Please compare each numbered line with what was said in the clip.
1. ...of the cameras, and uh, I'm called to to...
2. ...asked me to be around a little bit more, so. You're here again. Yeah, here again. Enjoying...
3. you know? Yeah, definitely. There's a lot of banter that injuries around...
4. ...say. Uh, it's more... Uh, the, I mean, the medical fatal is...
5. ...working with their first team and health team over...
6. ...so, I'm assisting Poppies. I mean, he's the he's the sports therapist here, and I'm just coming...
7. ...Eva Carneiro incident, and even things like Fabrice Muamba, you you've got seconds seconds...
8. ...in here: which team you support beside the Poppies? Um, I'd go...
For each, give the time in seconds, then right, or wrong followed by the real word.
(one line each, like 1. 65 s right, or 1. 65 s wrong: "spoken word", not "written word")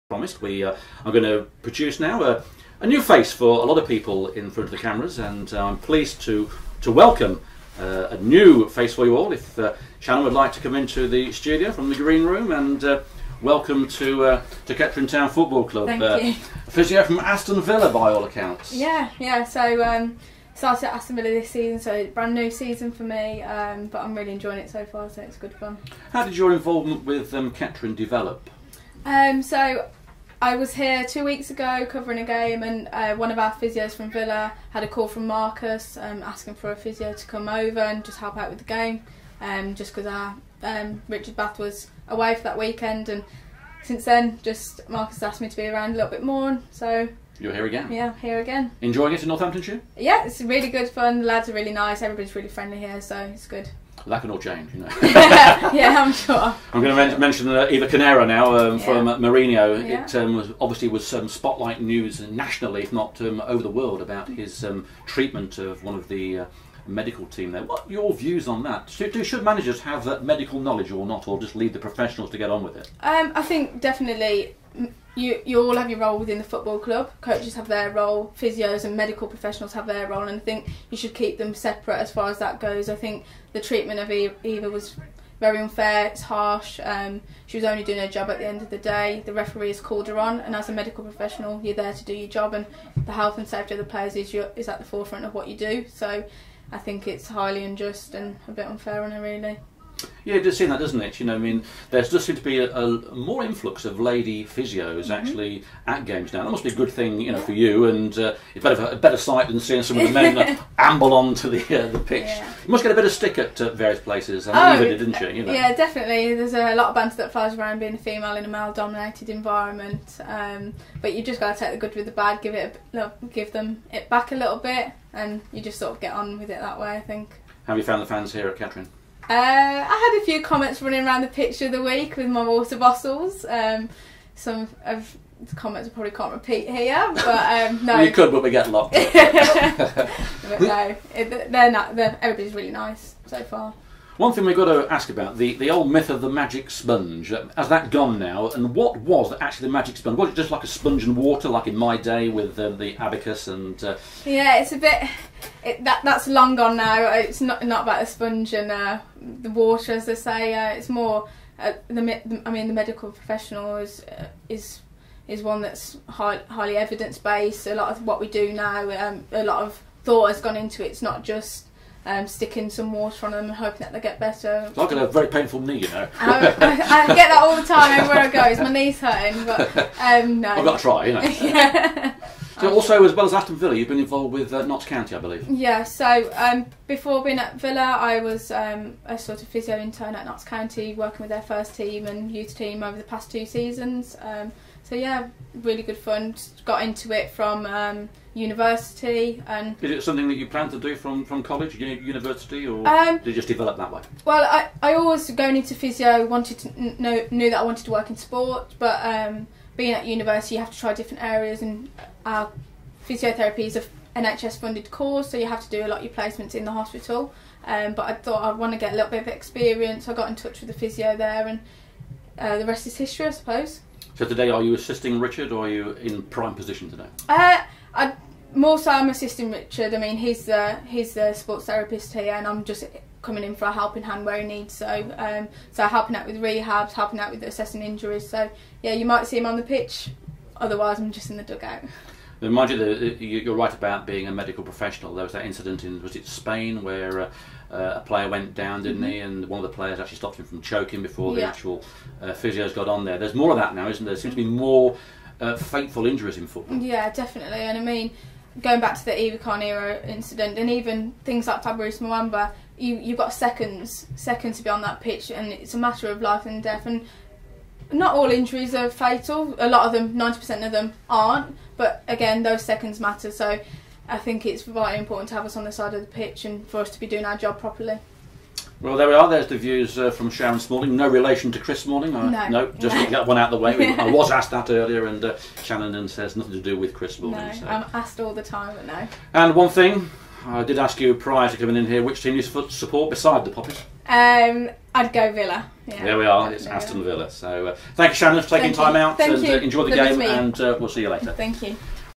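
1. 4 s wrong: "pleased", not "called"
2. 45 s right
3. 115 s wrong: "flies", not "injuries"
4. 160 s wrong: "professional", not "fatal"
5. 190 s wrong: "youth", not "health"
6. 228 s wrong: "Richard", not "Poppies"
7. 259 s right
8. 291 s right.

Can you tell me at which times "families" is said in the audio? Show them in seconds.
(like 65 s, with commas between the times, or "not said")
not said.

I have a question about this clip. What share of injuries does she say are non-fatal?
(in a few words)
90%.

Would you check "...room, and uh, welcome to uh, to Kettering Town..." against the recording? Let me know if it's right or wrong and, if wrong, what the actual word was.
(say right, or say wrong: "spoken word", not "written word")
right.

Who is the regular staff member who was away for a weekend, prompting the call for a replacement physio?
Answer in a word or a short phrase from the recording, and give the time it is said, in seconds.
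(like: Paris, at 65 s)
Richard Bath, at 41 s.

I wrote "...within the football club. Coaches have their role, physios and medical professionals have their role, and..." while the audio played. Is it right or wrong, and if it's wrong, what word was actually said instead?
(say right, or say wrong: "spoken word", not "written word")
right.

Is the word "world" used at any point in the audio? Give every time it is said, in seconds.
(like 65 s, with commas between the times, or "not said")
63 s.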